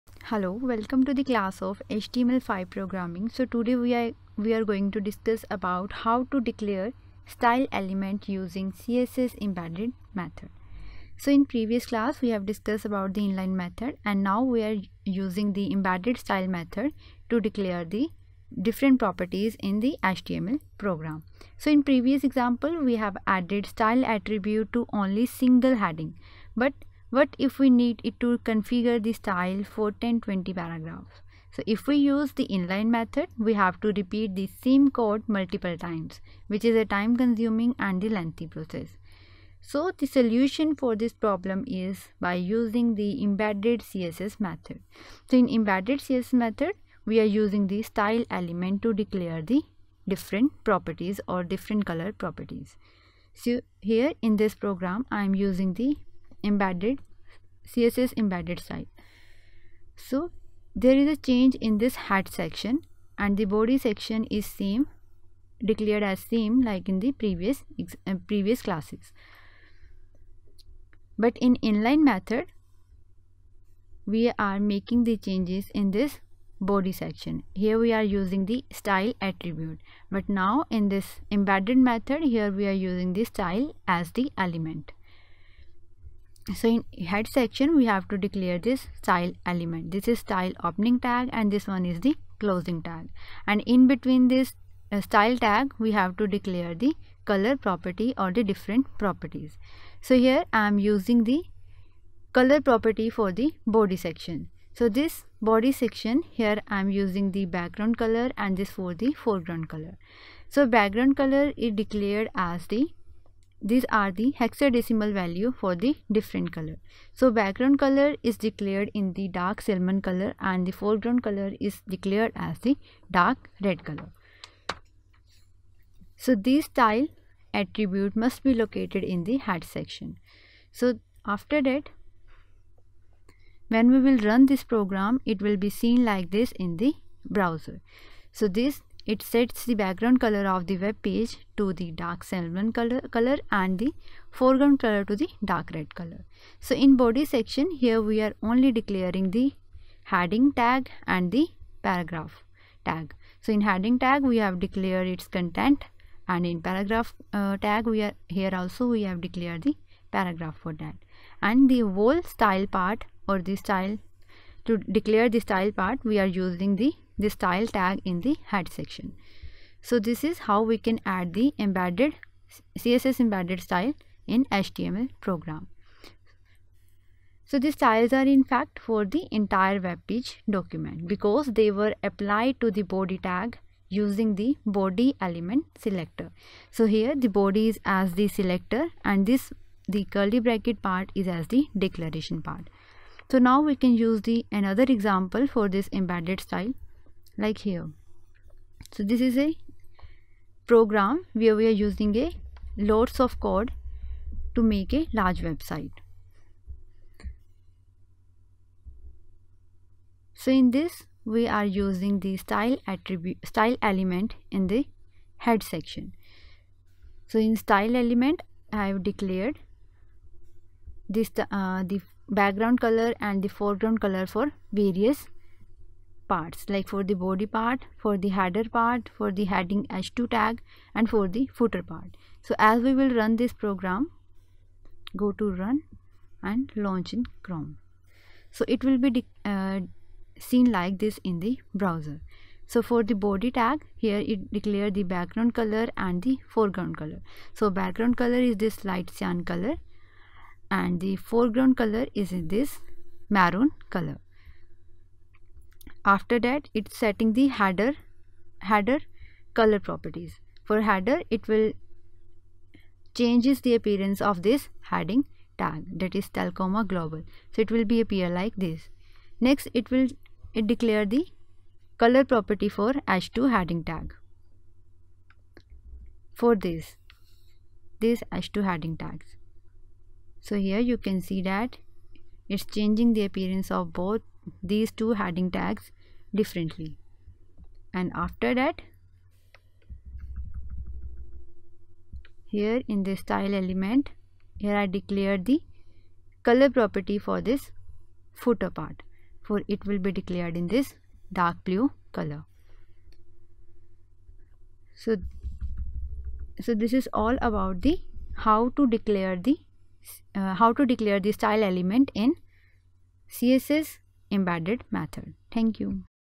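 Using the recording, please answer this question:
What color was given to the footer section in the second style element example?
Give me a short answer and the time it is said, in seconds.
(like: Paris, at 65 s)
dark blue, at 301 s.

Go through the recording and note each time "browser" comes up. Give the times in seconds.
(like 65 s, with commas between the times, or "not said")
137 s, 241 s.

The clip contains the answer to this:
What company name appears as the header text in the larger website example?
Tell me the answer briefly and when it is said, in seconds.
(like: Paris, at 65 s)
Telcoma Global, at 266 s.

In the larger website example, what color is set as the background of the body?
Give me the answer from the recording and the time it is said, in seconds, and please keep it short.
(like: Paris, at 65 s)
light cyan, at 248 s.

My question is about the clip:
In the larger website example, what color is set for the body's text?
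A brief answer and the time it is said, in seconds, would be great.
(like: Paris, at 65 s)
maroon, at 253 s.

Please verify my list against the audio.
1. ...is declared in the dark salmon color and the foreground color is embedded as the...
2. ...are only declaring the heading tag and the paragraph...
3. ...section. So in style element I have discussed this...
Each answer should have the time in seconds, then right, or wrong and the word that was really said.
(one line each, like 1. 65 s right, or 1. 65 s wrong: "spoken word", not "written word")
1. 118 s wrong: "declared", not "embedded"
2. 148 s right
3. 215 s wrong: "declared", not "discussed".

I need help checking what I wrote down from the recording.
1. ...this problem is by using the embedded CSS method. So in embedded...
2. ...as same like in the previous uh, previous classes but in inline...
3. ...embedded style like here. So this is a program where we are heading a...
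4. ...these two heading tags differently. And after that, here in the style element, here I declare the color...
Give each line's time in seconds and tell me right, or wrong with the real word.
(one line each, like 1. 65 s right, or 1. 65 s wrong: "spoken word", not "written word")
1. 40 s right
2. 66 s right
3. 195 s wrong: "using", not "heading"
4. 284 s right.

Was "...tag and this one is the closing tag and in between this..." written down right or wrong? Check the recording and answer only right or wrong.
right.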